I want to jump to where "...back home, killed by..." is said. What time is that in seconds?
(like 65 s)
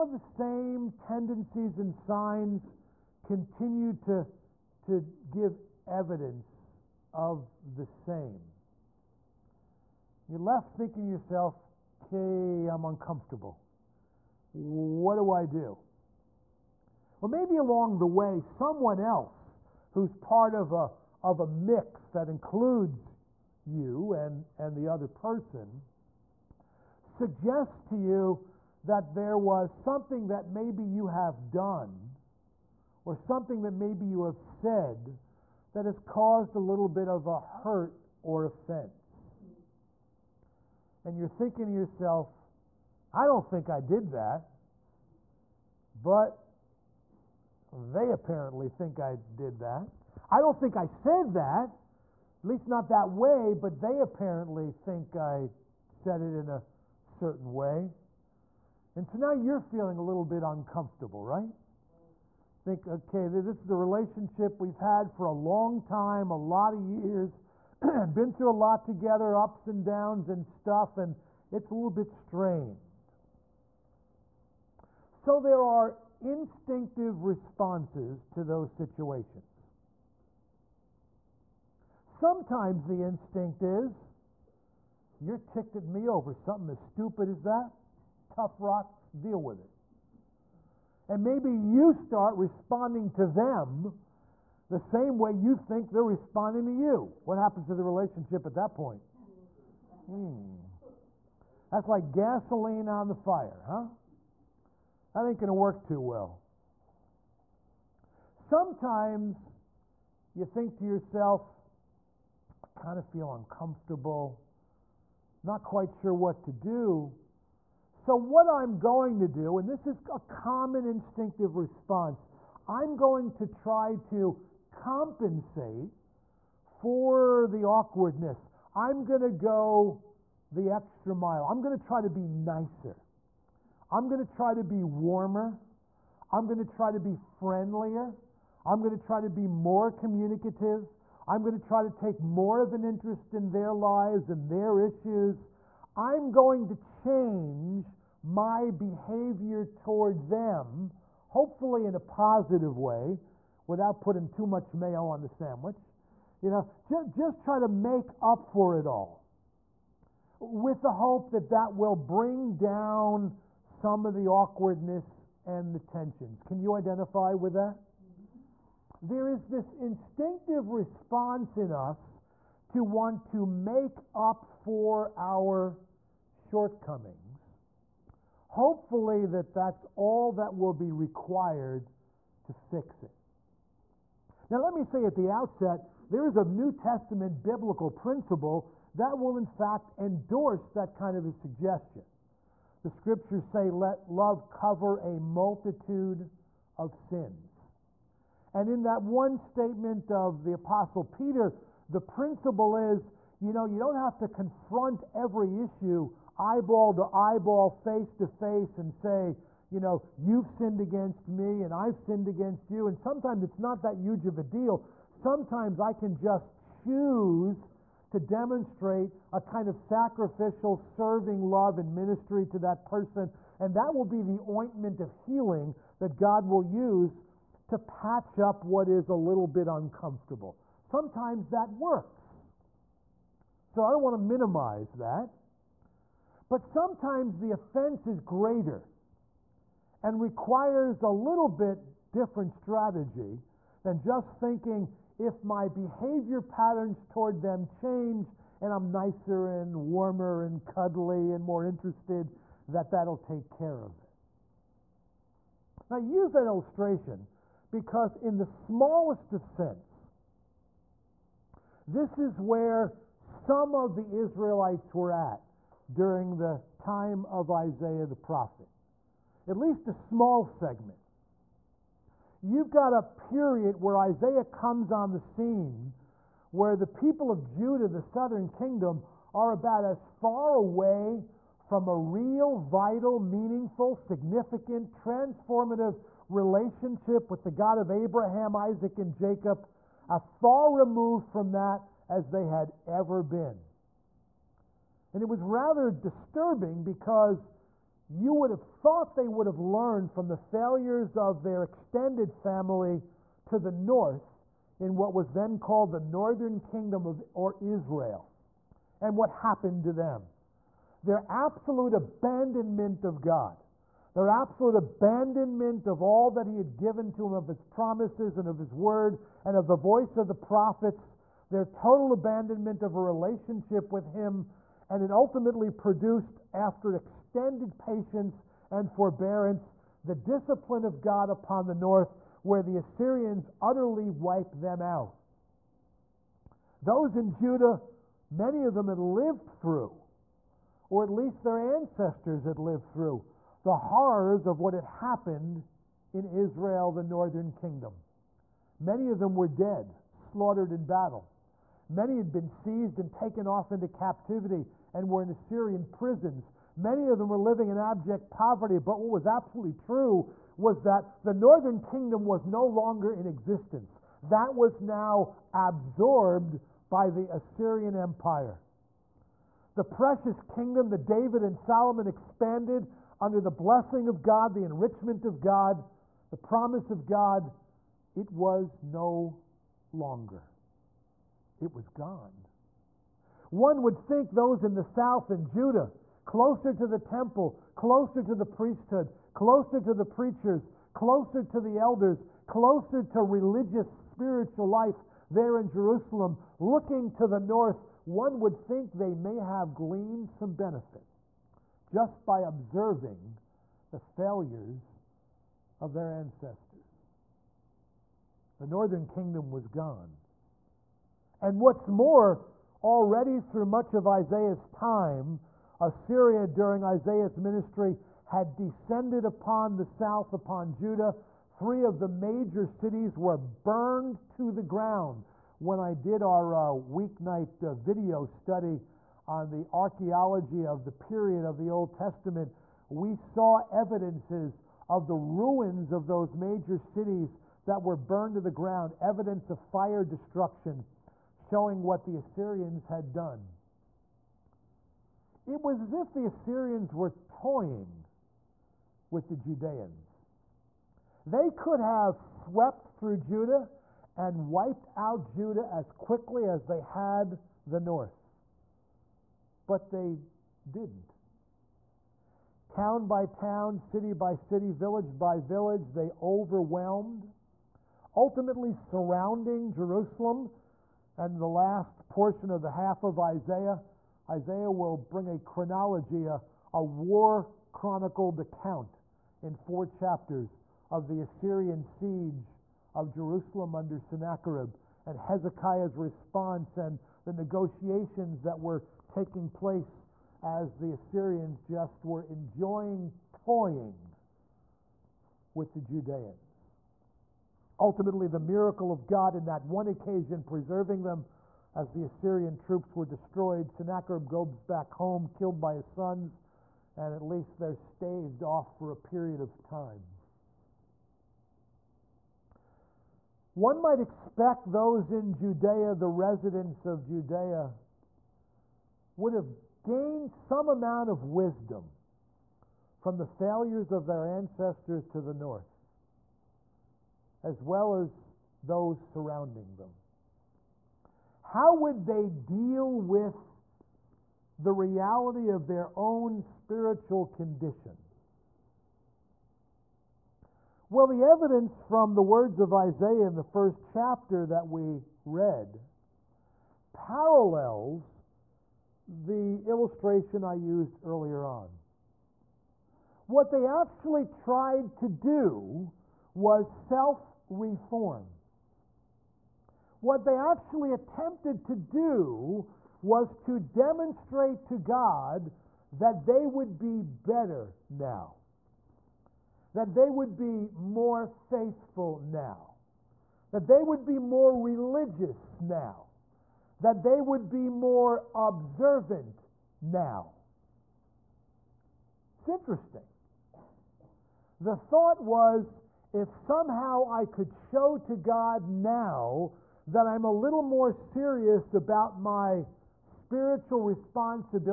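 504 s.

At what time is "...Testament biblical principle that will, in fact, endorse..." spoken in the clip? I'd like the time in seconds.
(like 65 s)
186 s.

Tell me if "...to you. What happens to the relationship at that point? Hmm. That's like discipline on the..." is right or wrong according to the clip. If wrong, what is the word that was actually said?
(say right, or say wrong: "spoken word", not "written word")
wrong: "gasoline", not "discipline".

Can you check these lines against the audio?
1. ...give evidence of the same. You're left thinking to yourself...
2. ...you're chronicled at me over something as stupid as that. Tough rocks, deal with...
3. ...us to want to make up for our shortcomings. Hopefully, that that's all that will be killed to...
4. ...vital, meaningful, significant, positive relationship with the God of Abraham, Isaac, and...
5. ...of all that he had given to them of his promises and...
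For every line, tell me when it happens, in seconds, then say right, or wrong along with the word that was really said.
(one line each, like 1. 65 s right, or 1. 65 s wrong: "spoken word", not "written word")
1. 5 s right
2. 85 s wrong: "ticked", not "chronicled"
3. 171 s wrong: "required", not "killed"
4. 282 s wrong: "transformative", not "positive"
5. 315 s right.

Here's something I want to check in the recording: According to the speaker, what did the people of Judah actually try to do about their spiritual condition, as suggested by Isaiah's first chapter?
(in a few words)
Self reform.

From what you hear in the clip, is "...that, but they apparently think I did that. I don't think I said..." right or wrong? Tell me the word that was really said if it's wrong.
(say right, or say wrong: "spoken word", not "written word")
right.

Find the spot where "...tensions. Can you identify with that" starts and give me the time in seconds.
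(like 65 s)
165 s.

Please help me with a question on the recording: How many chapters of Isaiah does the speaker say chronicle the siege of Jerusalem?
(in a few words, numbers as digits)
4.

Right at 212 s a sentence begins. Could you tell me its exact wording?
And sometimes it's not that huge of a deal.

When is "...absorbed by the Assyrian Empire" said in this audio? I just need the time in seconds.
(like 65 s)
365 s.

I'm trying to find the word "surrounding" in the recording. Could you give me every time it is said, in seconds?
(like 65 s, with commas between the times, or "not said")
468 s, 528 s.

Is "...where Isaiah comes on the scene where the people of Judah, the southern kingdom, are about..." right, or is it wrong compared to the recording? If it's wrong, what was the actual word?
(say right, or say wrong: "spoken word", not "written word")
right.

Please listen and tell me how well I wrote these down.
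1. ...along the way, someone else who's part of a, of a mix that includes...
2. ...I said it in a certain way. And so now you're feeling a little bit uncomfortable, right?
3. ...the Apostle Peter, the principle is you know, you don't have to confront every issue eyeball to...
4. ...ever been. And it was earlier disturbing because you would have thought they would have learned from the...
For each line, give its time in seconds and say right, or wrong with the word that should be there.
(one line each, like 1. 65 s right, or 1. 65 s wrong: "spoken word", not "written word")
1. 17 s right
2. 55 s right
3. 200 s right
4. 292 s wrong: "rather", not "earlier".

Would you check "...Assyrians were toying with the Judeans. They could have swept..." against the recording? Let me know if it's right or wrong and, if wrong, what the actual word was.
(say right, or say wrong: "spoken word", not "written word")
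right.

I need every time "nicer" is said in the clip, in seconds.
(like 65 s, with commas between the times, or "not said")
132 s, 248 s.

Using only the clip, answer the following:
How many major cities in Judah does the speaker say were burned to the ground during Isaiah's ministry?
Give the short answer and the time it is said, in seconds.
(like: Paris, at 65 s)
3, at 421 s.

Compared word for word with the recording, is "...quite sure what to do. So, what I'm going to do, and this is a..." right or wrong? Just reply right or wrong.
right.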